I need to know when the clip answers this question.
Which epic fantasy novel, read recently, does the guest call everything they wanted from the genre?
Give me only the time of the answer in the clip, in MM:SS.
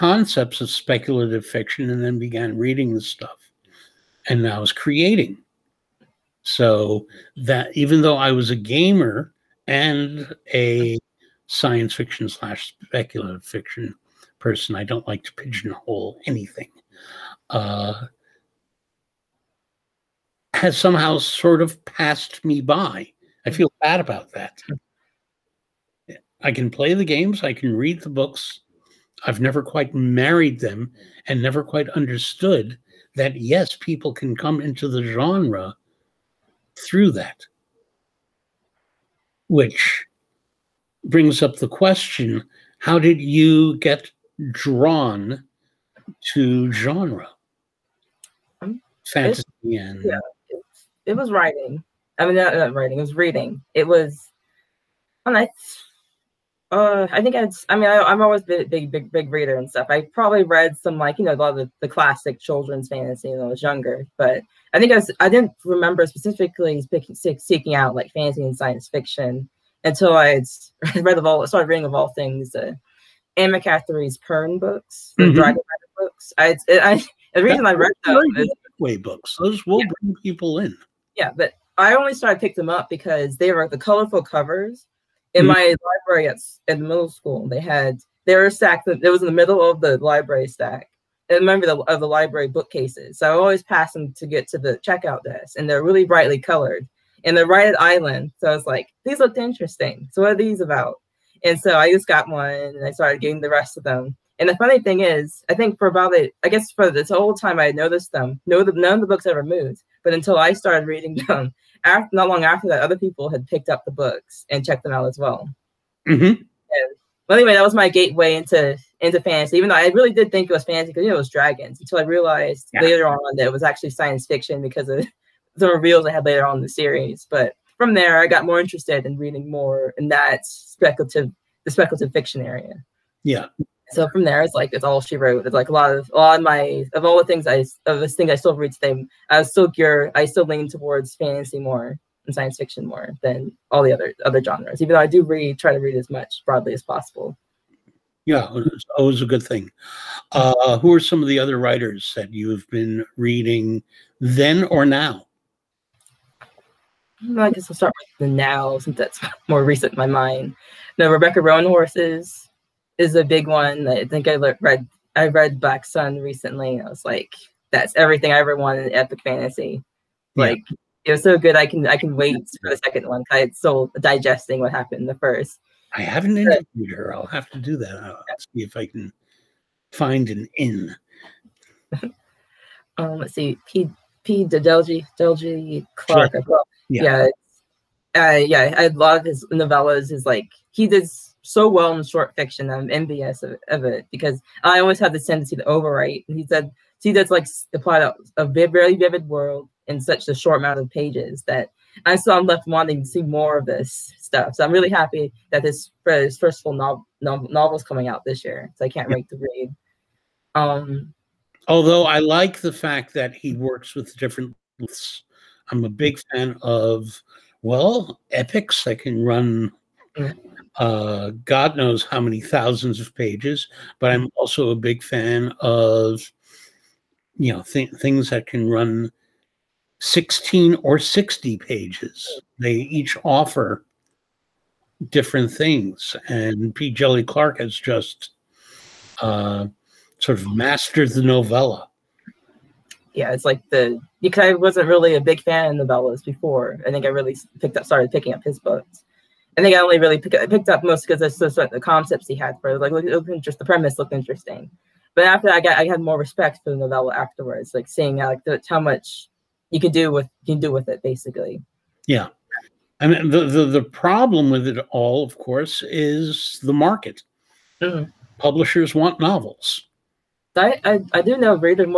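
02:45.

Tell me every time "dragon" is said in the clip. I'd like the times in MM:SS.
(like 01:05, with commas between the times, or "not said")
01:15, 02:01.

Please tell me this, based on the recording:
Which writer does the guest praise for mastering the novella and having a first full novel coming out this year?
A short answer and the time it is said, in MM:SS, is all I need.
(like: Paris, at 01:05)
P. Djèlí Clark, at 03:56.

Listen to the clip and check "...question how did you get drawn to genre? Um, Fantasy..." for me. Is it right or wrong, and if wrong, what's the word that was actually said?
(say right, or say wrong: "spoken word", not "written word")
right.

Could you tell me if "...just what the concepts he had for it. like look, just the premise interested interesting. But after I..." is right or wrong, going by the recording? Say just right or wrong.
wrong.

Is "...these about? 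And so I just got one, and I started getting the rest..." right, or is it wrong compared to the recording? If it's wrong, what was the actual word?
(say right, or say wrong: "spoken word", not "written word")
right.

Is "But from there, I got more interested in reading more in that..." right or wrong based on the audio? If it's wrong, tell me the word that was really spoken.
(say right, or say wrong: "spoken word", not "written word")
right.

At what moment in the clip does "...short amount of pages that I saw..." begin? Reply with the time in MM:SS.
03:20.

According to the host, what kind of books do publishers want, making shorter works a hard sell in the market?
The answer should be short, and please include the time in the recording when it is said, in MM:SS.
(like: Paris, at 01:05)
Novels, at 04:29.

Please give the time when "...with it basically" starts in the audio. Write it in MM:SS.
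04:20.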